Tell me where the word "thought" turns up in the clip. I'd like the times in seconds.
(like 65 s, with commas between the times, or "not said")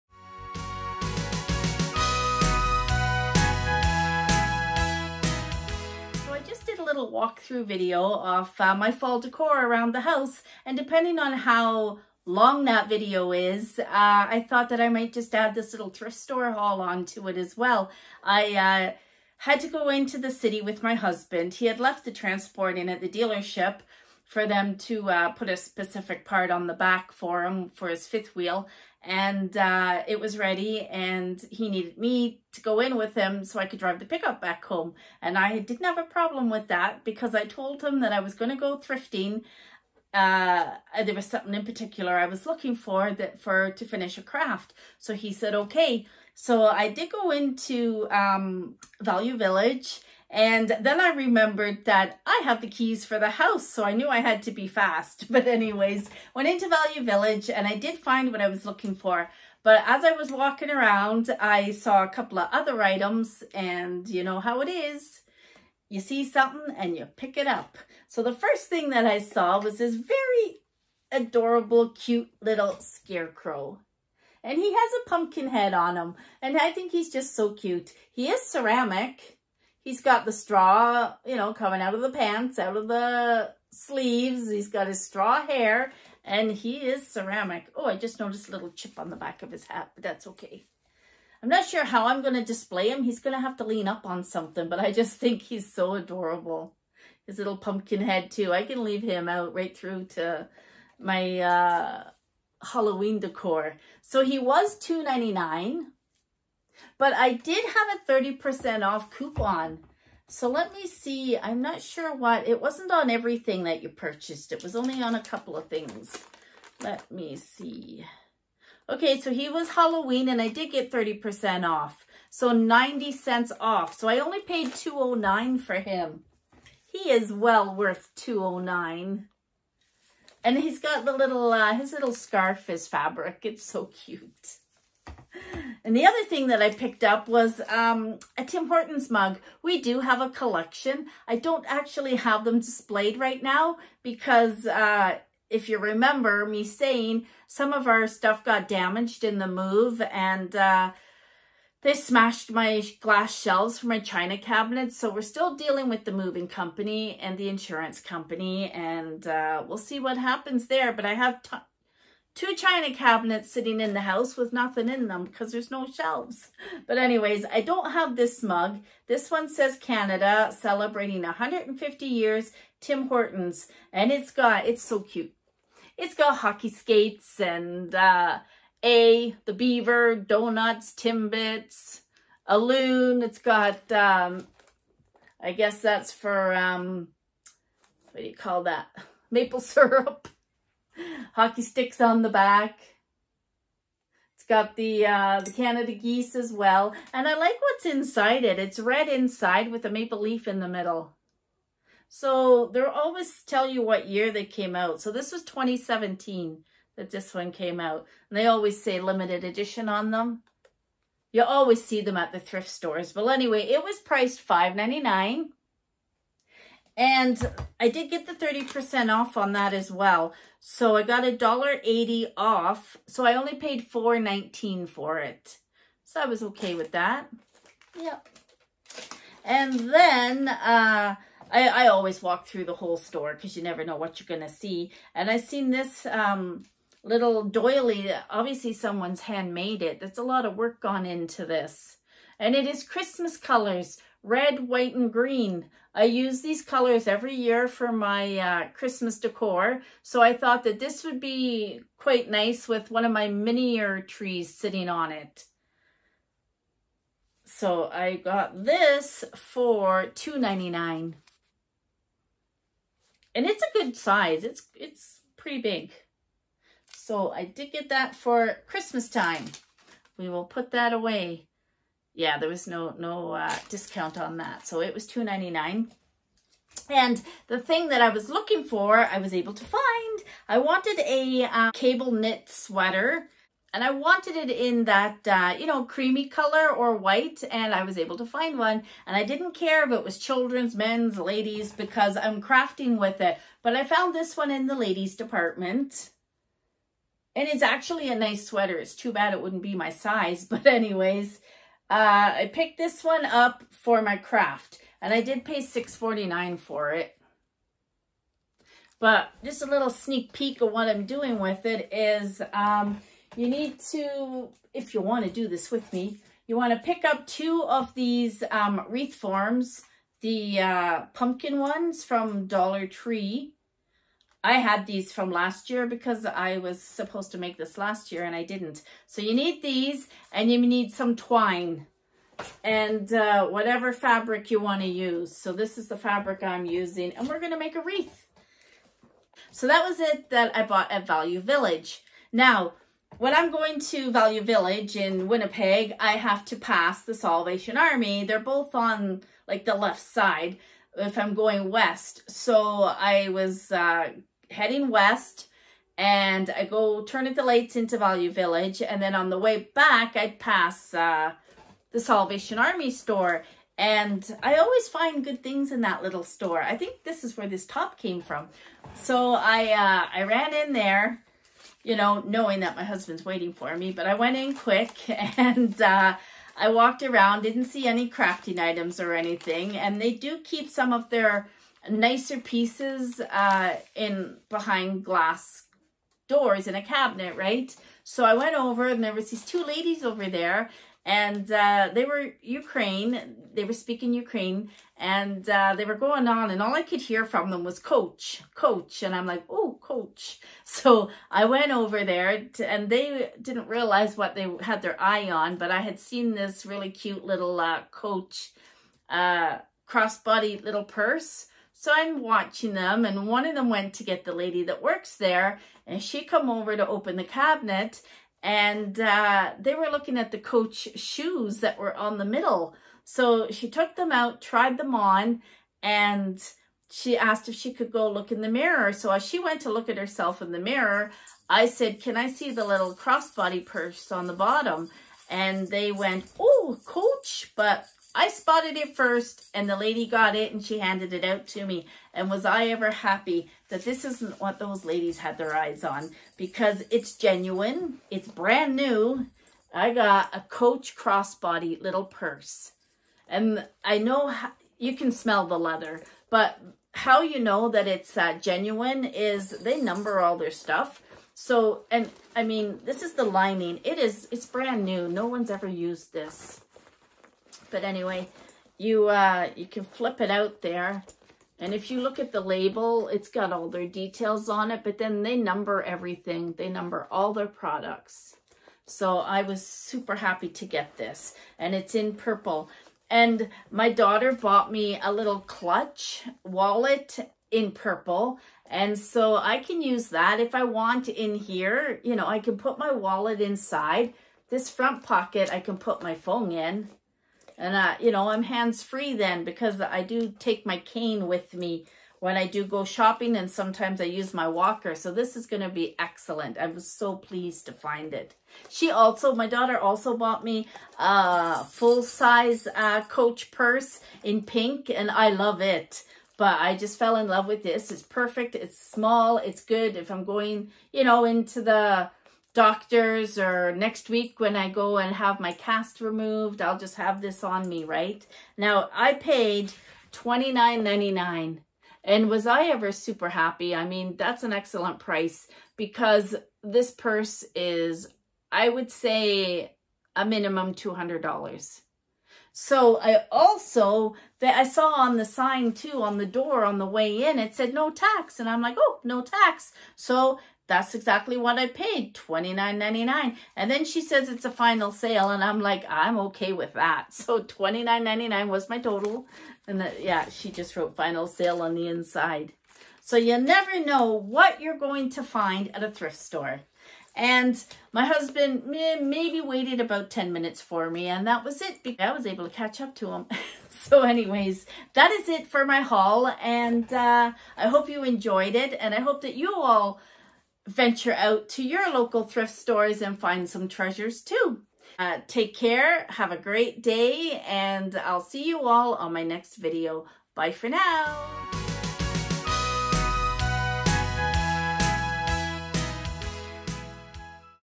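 14 s, 250 s.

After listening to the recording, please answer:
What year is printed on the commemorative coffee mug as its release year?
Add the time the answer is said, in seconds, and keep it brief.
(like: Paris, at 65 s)
2017, at 205 s.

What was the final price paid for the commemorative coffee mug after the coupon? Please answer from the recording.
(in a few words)
$4.19.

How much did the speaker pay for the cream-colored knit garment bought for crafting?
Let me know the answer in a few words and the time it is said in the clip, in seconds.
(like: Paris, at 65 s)
$6.49, at 305 s.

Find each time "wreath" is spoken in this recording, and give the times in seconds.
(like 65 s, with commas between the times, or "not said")
318 s, 337 s.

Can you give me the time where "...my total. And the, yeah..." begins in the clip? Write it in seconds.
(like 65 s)
558 s.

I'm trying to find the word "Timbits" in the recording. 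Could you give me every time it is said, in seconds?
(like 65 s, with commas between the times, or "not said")
180 s.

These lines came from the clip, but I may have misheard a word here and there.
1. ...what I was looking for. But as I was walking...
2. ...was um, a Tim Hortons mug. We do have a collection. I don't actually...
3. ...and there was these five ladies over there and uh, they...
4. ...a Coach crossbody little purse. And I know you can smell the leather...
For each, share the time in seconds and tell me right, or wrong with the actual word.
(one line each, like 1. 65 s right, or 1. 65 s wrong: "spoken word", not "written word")
1. 58 s right
2. 137 s right
3. 388 s wrong: "two", not "five"
4. 450 s right.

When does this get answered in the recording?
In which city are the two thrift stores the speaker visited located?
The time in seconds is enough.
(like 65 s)
345 s.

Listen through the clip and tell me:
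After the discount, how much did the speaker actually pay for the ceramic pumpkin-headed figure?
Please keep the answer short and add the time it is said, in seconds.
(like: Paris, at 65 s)
$2.09, at 124 s.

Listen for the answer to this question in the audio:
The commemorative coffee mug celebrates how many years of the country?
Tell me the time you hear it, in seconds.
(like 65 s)
171 s.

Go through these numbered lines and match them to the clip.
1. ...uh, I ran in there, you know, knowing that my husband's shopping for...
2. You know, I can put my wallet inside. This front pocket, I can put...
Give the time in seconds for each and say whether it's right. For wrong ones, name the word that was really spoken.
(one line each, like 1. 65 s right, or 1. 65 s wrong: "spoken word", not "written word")
1. 369 s wrong: "waiting", not "shopping"
2. 492 s right.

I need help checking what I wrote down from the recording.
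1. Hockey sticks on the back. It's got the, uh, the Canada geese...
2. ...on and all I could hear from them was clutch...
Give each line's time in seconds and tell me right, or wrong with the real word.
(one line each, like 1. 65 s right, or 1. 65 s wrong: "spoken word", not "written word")
1. 191 s right
2. 396 s wrong: "coach", not "clutch".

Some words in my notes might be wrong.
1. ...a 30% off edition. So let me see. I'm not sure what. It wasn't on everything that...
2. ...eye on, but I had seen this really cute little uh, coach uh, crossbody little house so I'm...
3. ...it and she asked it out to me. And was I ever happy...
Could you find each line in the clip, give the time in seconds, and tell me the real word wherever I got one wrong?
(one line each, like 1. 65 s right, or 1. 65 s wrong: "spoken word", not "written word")
1. 107 s wrong: "coupon", not "edition"
2. 405 s wrong: "purse", not "house"
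3. 440 s wrong: "handed", not "asked".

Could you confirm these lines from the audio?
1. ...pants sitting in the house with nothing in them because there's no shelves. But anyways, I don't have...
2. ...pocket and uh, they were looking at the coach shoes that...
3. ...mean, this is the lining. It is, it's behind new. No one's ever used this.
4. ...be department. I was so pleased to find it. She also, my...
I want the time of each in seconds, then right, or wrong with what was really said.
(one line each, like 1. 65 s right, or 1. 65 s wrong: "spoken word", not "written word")
1. 162 s wrong: "cabinets", not "pants"
2. 417 s wrong: "cabinet", not "pocket"
3. 462 s wrong: "brand", not "behind"
4. 505 s wrong: "excellent", not "department".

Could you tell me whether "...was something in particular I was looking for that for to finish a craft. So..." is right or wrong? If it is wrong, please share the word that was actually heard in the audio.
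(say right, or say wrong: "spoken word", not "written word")
right.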